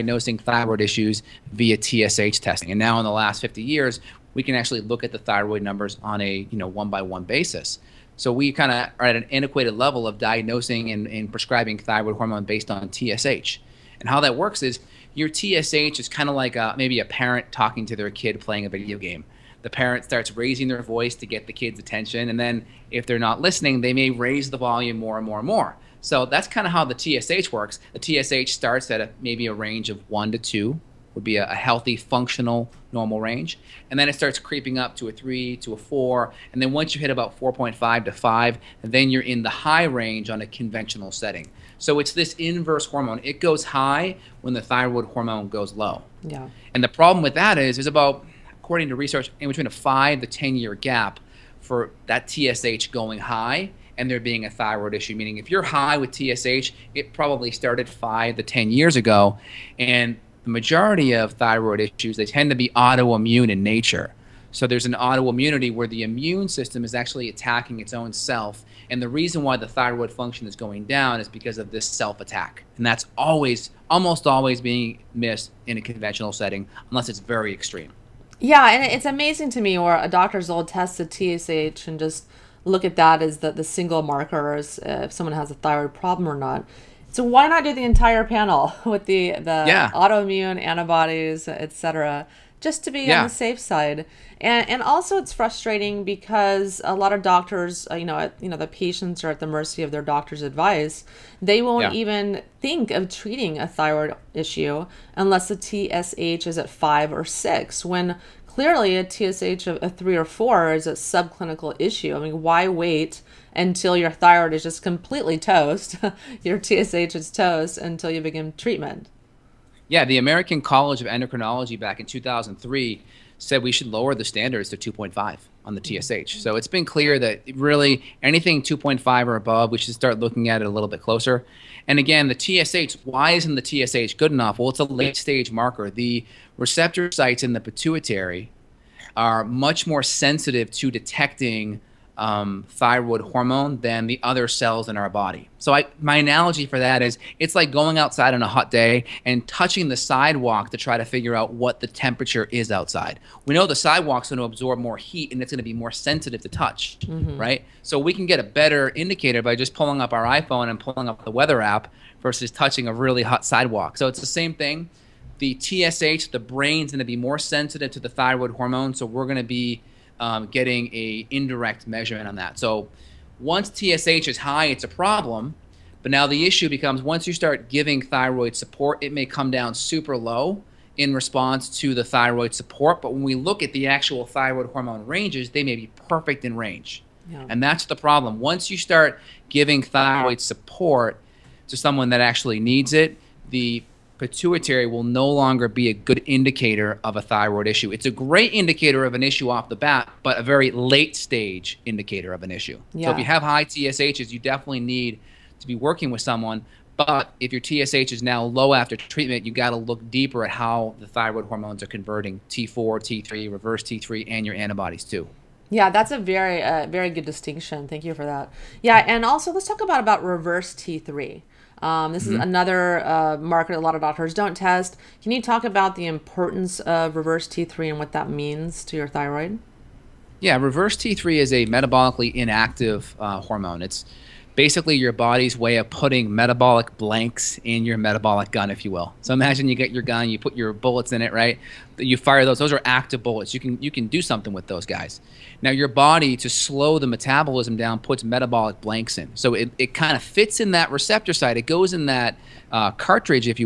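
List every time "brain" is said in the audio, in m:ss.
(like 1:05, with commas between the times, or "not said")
2:46.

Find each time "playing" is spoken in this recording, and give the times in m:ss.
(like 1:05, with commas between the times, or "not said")
0:18.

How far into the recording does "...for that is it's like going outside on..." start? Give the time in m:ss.
2:26.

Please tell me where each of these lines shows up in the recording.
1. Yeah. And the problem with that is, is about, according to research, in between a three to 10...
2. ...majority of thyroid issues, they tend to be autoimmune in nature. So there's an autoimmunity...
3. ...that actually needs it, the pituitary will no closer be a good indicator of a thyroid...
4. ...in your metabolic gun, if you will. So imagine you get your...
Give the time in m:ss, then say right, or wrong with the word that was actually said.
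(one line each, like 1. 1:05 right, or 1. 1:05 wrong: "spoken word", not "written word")
1. 0:46 wrong: "five", not "three"
2. 1:00 right
3. 3:12 wrong: "longer", not "closer"
4. 3:57 right.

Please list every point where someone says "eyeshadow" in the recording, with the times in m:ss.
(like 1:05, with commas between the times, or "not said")
not said.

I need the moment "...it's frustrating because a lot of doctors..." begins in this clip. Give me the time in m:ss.
1:35.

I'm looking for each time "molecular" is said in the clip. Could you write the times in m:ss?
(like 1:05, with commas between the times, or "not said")
not said.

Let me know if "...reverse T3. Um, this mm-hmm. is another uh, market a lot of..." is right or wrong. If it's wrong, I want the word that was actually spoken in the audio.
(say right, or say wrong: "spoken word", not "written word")
right.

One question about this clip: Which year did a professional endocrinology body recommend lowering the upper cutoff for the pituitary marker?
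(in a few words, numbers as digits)
2003.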